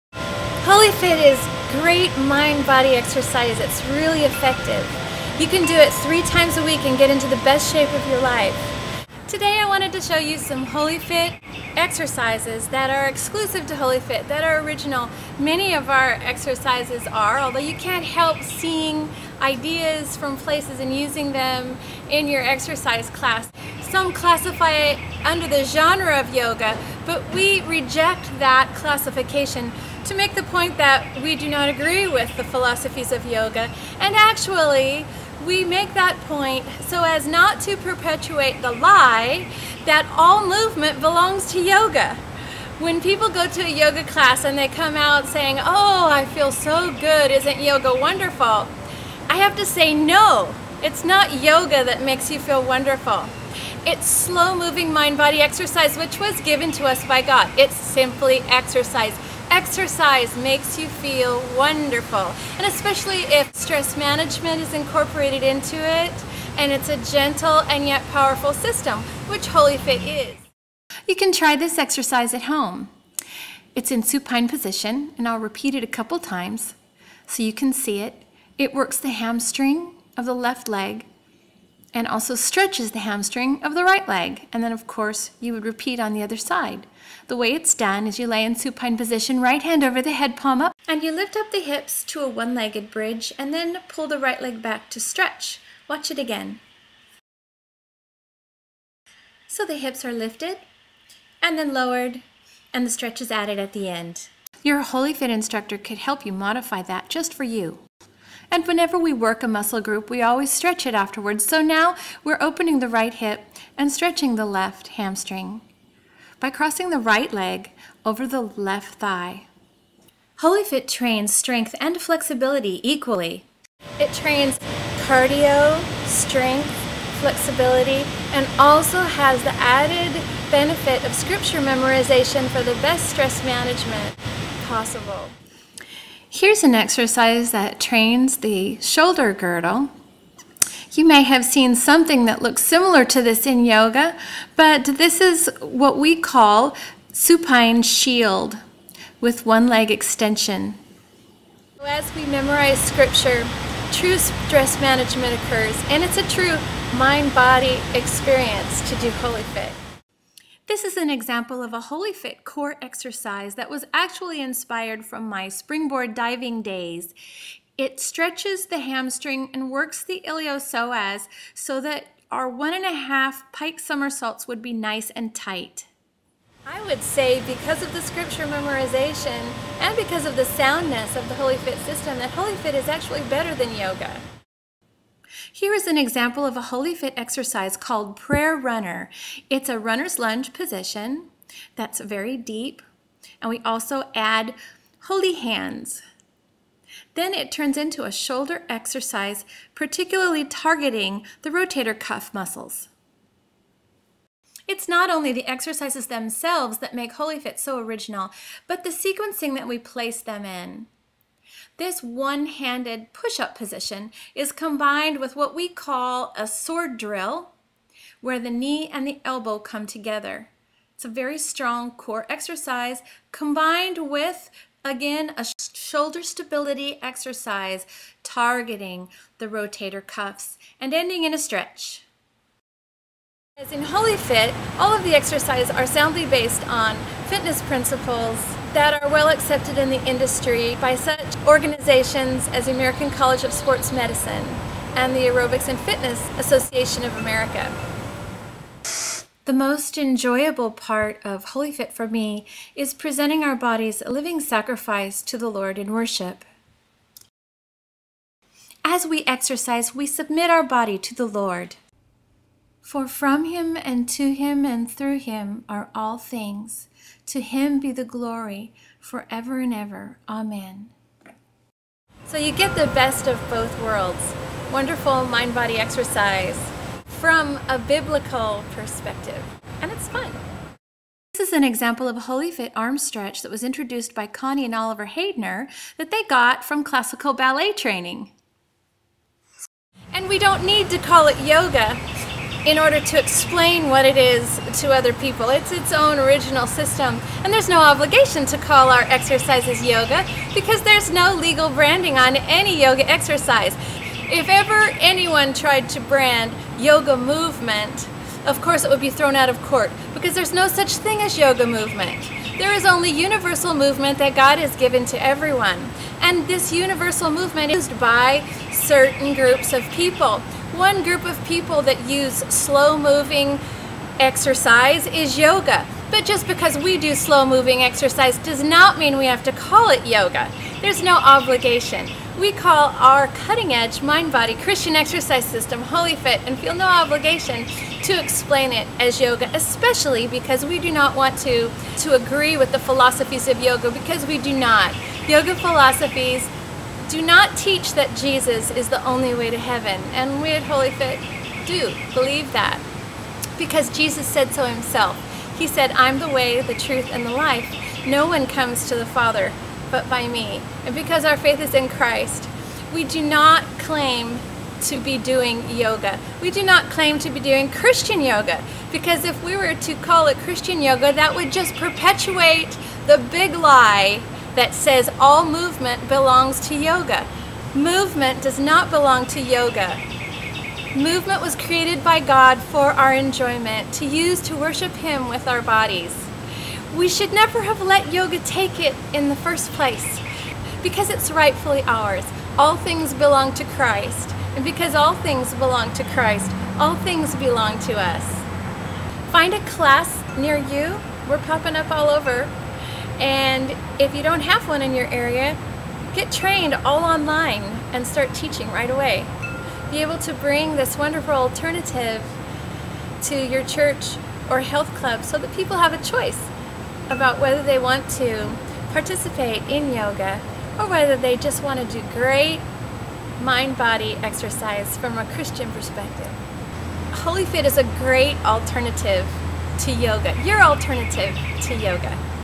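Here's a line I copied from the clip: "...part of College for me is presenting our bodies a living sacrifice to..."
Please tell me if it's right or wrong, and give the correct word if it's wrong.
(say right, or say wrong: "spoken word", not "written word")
wrong: "WholyFit", not "College".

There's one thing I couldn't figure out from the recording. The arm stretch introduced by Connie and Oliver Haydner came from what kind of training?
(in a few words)
Classical ballet.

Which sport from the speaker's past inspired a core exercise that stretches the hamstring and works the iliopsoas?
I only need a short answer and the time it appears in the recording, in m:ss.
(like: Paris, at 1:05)
Springboard diving, at 2:45.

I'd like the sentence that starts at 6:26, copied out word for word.
We should never have let yoga take it in the first place because it's rightfully ours.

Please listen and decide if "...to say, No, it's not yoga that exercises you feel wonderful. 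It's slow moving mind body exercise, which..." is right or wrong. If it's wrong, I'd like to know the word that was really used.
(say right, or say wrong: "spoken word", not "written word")
wrong: "makes", not "exercises".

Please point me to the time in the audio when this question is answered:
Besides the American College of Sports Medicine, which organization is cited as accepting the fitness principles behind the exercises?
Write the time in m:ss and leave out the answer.
4:05.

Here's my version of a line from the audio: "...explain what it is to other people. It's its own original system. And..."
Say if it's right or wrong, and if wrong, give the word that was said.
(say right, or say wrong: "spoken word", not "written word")
right.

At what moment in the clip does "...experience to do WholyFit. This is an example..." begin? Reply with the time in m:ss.
2:37.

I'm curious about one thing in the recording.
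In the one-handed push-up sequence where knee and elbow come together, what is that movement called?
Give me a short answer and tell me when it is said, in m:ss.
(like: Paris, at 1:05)
Sword drill, at 3:36.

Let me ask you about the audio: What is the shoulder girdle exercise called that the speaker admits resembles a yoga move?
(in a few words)
Supine shield with one leg extension.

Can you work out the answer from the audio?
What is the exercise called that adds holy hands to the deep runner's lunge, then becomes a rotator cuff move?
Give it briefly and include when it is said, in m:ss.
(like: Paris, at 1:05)
Prayer Runner, at 3:08.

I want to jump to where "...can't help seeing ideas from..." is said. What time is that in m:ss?
0:17.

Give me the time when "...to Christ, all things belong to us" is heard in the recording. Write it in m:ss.
6:35.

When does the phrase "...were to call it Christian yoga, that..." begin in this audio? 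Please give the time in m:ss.
6:09.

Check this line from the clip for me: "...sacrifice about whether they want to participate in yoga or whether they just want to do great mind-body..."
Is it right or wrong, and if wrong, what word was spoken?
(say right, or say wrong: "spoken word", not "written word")
wrong: "choice", not "sacrifice".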